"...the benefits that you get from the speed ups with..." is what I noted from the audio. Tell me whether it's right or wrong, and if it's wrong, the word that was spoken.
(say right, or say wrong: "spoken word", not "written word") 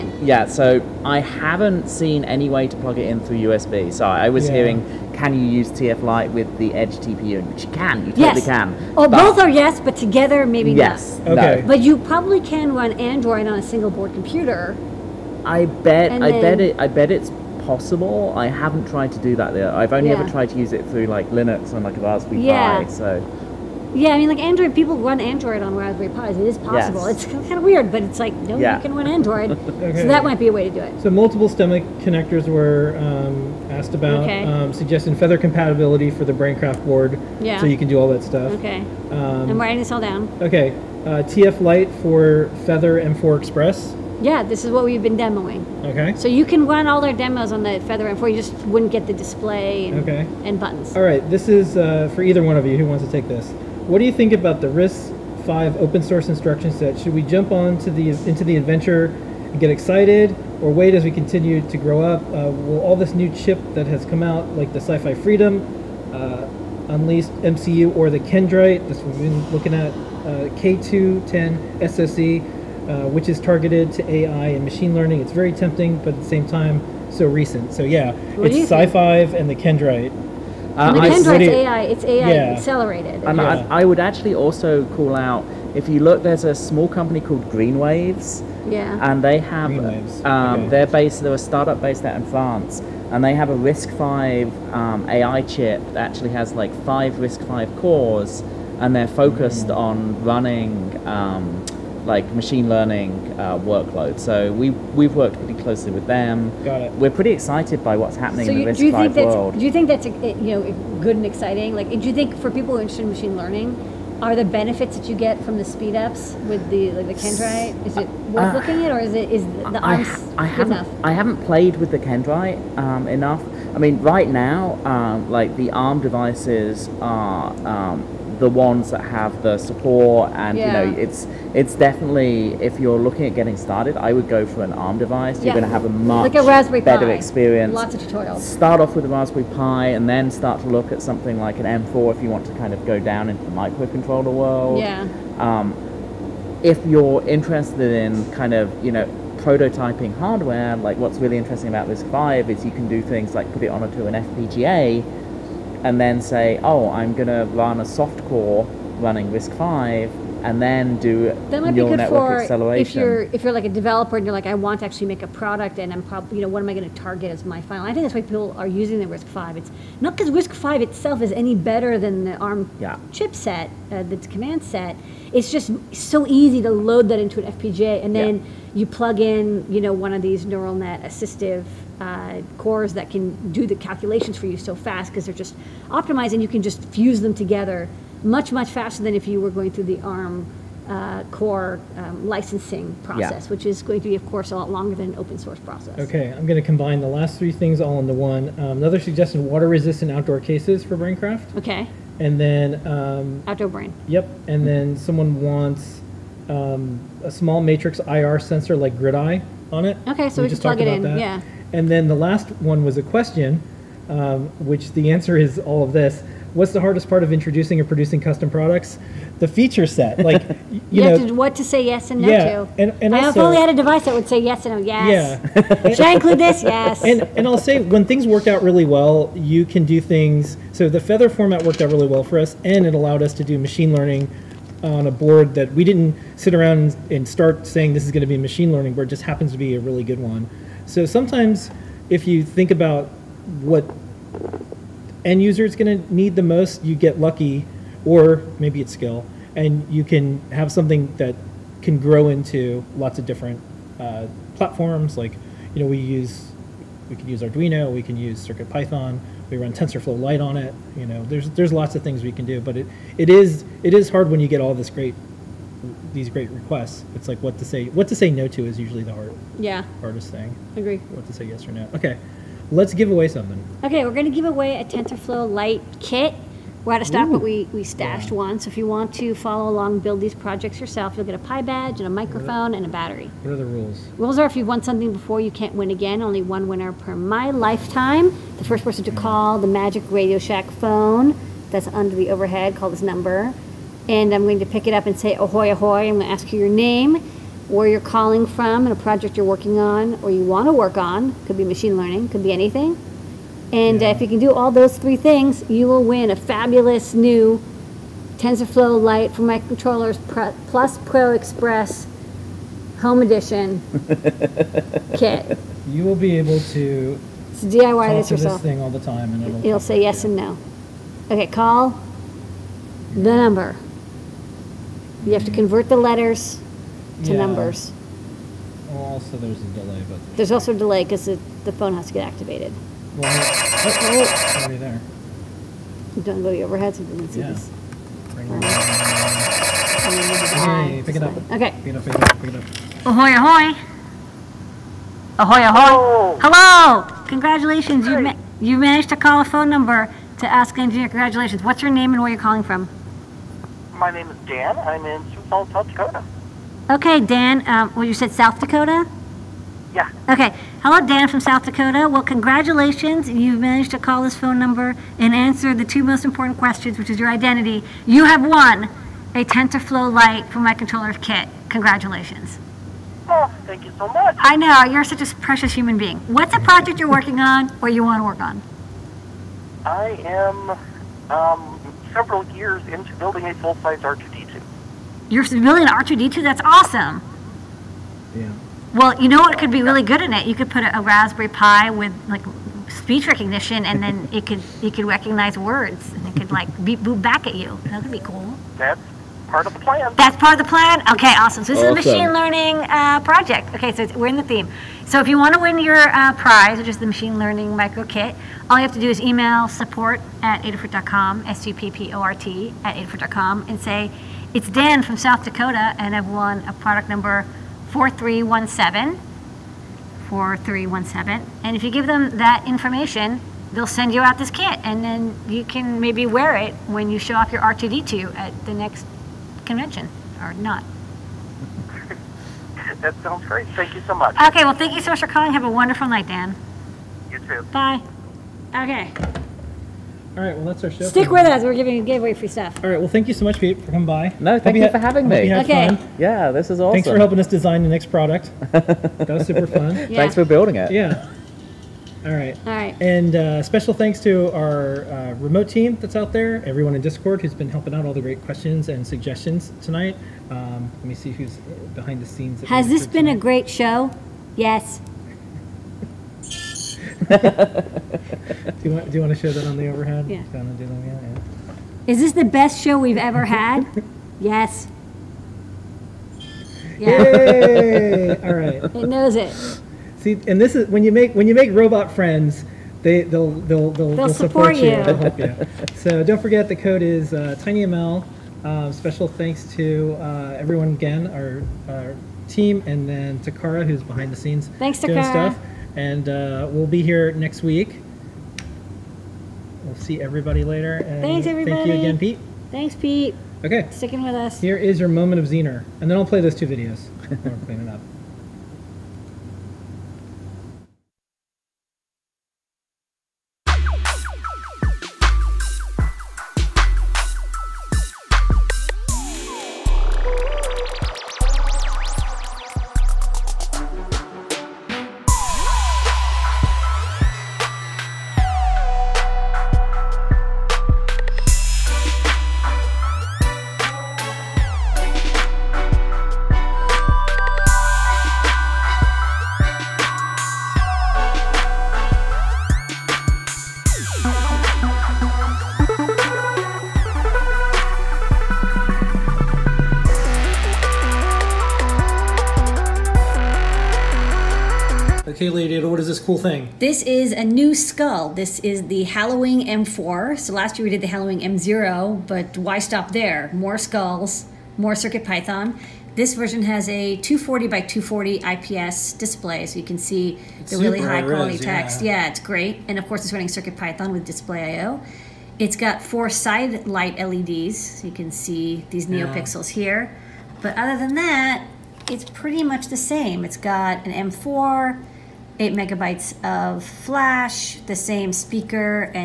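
right.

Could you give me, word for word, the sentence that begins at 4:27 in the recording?
It's like what to say what to say no to is usually the hard yeah hardest thing.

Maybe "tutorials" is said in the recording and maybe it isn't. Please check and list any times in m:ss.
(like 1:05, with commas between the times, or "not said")
2:18.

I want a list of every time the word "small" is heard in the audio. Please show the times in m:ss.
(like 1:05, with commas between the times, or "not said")
1:26, 3:27.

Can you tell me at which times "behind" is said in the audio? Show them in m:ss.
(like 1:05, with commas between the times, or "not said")
7:41, 8:14.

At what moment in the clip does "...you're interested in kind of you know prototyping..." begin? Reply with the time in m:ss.
2:26.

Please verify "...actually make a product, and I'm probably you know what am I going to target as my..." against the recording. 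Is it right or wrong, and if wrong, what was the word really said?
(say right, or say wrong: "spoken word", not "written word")
right.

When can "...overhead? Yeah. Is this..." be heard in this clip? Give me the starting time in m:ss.
7:49.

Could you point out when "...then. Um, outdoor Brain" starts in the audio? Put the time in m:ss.
3:22.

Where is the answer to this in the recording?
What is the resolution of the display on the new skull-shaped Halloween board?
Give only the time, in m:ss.
9:27.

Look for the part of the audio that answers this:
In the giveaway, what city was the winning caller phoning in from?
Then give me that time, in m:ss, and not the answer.
5:55.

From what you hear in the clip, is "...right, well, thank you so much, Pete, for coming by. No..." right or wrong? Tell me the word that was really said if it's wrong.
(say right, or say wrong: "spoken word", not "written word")
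right.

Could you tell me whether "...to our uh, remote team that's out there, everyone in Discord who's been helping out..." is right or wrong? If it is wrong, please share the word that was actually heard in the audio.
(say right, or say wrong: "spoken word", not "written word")
right.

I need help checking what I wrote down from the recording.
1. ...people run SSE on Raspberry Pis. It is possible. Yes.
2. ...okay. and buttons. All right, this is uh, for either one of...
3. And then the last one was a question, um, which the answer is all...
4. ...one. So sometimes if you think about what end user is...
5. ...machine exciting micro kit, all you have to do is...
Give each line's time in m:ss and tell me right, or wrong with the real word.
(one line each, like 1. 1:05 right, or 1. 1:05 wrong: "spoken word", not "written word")
1. 0:24 wrong: "Android", not "SSE"
2. 0:50 right
3. 3:31 right
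4. 4:00 right
5. 6:47 wrong: "learning", not "exciting".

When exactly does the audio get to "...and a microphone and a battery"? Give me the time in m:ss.
4:41.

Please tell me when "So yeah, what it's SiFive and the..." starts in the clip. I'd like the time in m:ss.
1:17.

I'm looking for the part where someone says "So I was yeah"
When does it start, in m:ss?
0:03.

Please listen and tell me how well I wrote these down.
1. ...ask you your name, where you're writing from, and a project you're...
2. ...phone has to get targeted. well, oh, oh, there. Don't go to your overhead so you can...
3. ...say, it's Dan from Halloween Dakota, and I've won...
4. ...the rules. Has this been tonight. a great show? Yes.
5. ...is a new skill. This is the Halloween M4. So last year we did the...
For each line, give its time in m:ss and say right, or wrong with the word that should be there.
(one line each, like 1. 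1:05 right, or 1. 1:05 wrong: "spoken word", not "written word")
1. 4:56 wrong: "calling", not "writing"
2. 5:31 wrong: "activated", not "targeted"
3. 6:53 wrong: "South", not "Halloween"
4. 7:42 wrong: "scenes", not "rules"
5. 9:17 wrong: "skull", not "skill".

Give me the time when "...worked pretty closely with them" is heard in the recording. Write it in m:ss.
1:45.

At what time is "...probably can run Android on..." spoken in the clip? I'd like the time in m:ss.
0:11.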